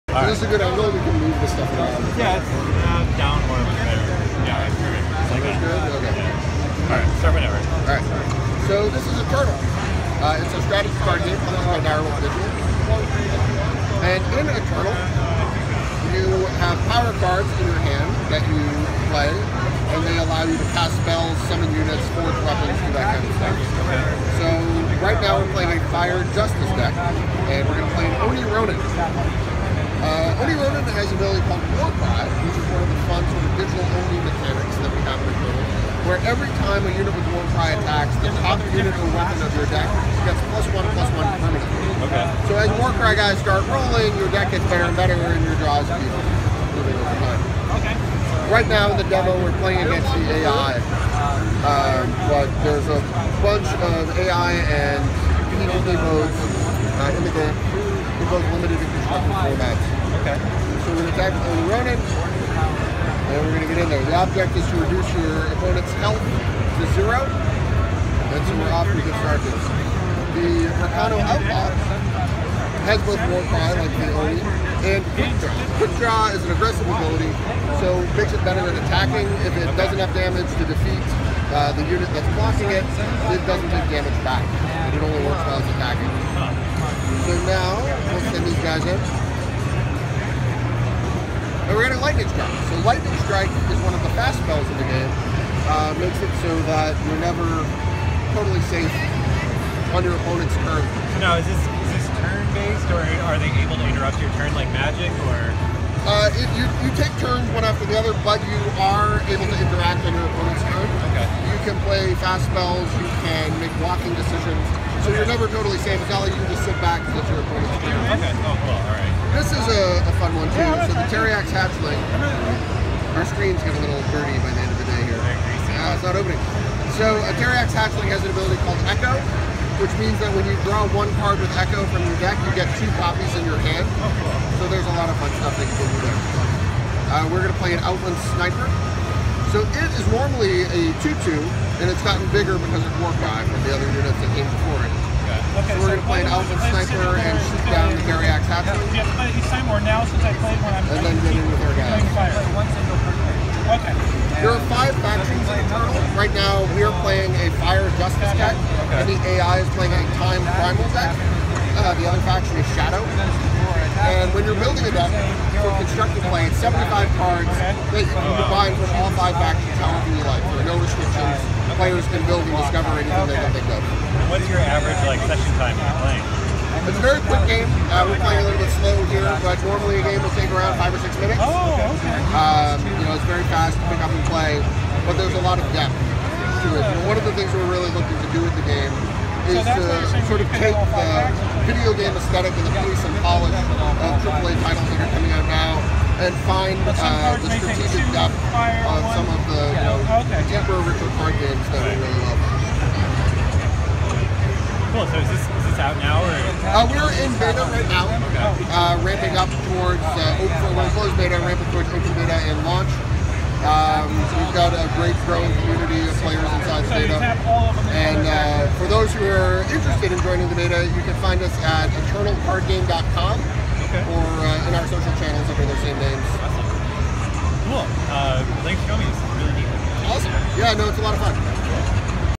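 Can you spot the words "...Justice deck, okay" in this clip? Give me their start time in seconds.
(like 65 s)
157 s.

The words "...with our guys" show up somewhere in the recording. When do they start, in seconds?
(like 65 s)
151 s.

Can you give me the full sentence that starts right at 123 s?
Our screen's getting a little dirty by the end of the day here.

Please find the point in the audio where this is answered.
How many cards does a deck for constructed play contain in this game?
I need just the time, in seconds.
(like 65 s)
166 s.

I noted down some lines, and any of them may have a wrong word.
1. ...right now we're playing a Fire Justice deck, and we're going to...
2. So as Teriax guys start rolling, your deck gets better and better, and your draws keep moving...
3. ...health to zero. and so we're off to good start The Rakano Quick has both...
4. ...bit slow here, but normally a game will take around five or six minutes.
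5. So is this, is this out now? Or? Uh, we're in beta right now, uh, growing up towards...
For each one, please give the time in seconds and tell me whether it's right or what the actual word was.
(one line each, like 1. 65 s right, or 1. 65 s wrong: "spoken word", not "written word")
1. 25 s right
2. 42 s wrong: "Warcry", not "Teriax"
3. 65 s wrong: "Outlaw", not "Quick"
4. 178 s right
5. 205 s wrong: "ramping", not "growing".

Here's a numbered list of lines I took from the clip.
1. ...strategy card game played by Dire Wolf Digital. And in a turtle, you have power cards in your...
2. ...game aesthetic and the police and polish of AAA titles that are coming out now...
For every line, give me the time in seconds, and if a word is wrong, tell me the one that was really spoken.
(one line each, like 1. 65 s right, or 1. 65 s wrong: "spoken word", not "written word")
1. 10 s right
2. 191 s right.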